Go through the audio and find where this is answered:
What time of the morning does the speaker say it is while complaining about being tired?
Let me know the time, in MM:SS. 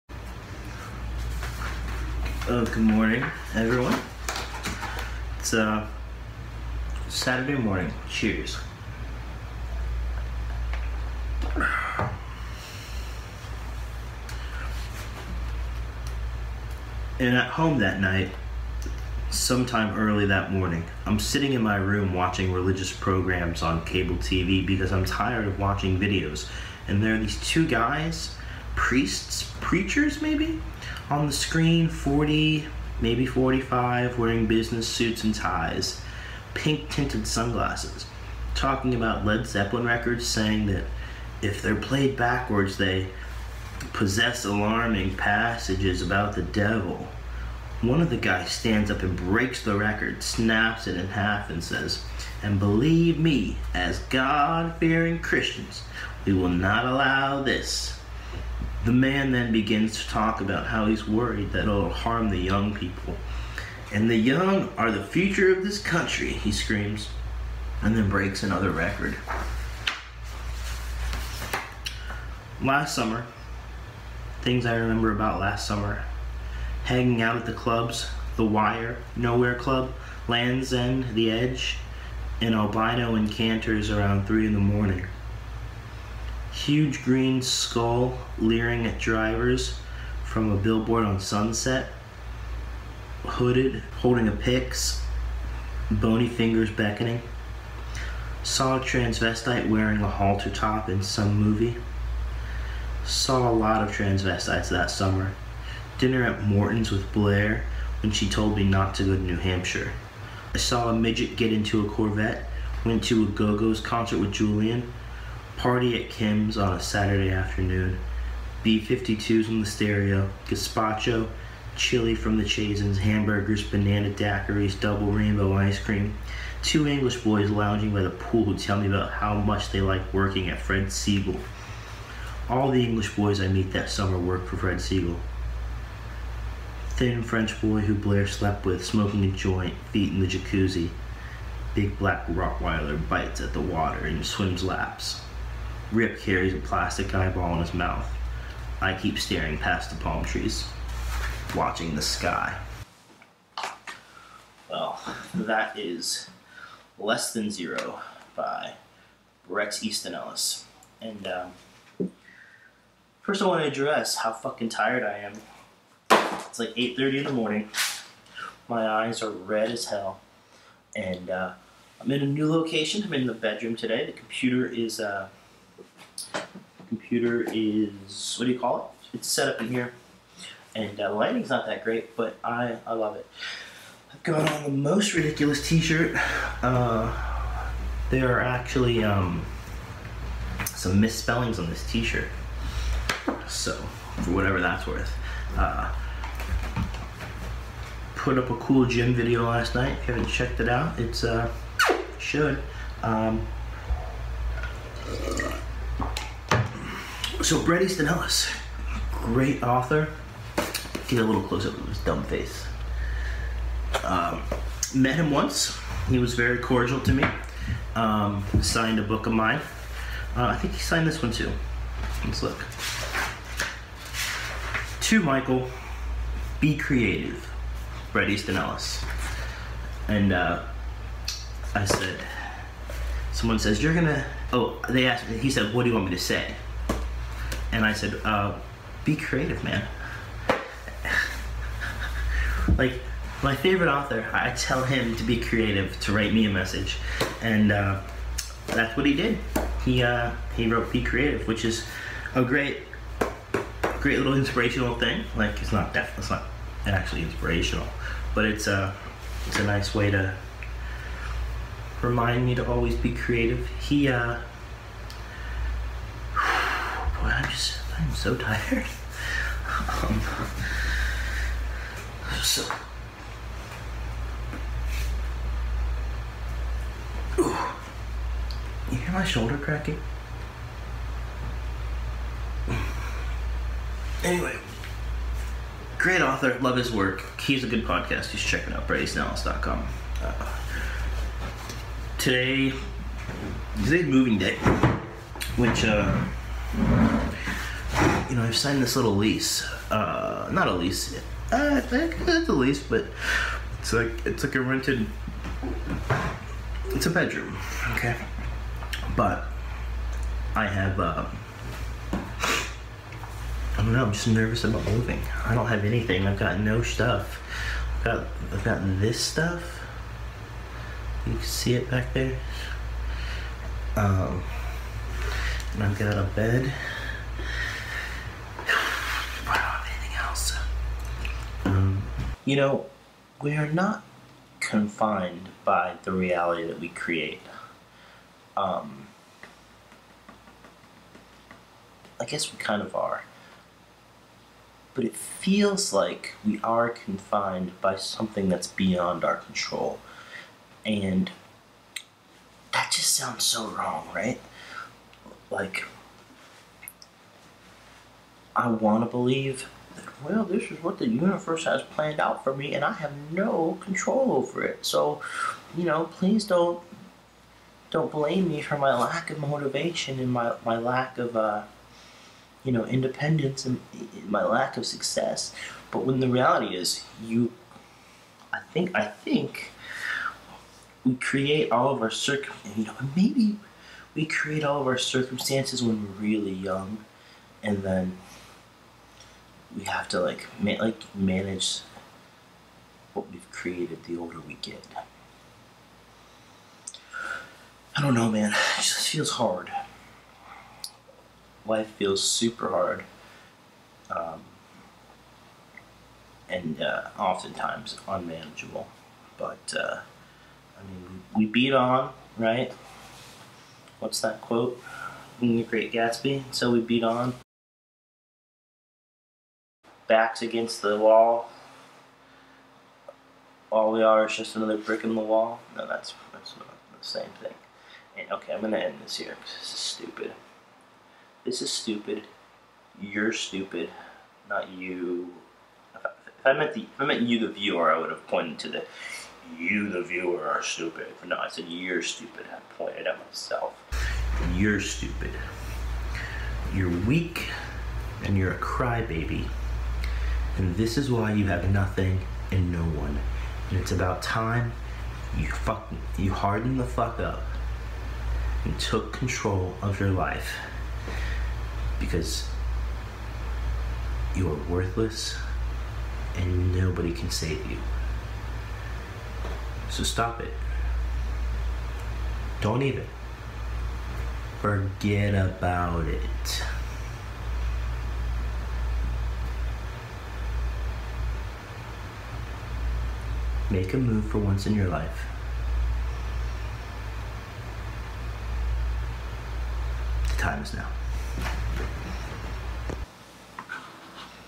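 02:46.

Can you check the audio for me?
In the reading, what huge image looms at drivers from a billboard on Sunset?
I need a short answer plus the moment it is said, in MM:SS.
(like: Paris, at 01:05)
green skull, at 01:27.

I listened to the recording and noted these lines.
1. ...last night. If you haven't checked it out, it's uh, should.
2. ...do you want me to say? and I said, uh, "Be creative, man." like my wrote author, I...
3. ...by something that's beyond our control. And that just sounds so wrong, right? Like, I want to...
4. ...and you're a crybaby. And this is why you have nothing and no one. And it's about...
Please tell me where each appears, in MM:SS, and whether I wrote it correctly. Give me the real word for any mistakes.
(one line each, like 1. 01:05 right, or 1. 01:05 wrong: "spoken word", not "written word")
1. 03:19 right
2. 03:55 wrong: "favorite", not "wrote"
3. 05:47 right
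4. 07:28 right.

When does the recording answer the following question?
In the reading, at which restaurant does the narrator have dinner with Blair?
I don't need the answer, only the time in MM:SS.
01:46.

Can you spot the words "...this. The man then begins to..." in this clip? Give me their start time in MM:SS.
00:57.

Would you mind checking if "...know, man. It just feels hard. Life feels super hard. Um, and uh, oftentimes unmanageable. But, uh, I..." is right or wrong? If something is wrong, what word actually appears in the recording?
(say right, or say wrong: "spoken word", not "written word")
right.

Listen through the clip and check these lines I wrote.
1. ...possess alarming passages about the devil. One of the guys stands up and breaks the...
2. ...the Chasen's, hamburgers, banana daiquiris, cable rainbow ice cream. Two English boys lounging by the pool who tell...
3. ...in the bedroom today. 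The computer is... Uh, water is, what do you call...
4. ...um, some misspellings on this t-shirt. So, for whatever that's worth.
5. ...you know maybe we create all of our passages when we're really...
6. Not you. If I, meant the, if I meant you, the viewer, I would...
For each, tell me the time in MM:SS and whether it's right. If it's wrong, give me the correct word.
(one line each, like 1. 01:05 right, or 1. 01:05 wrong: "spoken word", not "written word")
1. 00:43 right
2. 02:02 wrong: "double", not "cable"
3. 02:53 wrong: "computer", not "water"
4. 03:09 right
5. 06:22 wrong: "circumstances", not "passages"
6. 07:14 right.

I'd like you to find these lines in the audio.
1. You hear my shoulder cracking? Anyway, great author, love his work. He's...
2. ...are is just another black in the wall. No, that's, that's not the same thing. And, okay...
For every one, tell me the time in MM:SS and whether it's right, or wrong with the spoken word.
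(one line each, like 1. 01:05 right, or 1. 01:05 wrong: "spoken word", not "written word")
1. 04:38 right
2. 07:04 wrong: "brick", not "black".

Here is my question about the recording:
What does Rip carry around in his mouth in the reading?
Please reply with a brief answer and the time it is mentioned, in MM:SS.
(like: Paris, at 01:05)
plastic eyeball, at 02:26.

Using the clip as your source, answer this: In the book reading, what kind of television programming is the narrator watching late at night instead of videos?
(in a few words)
religious programs.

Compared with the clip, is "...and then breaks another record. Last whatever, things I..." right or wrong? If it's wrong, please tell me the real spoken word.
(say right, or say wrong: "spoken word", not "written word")
wrong: "summer", not "whatever".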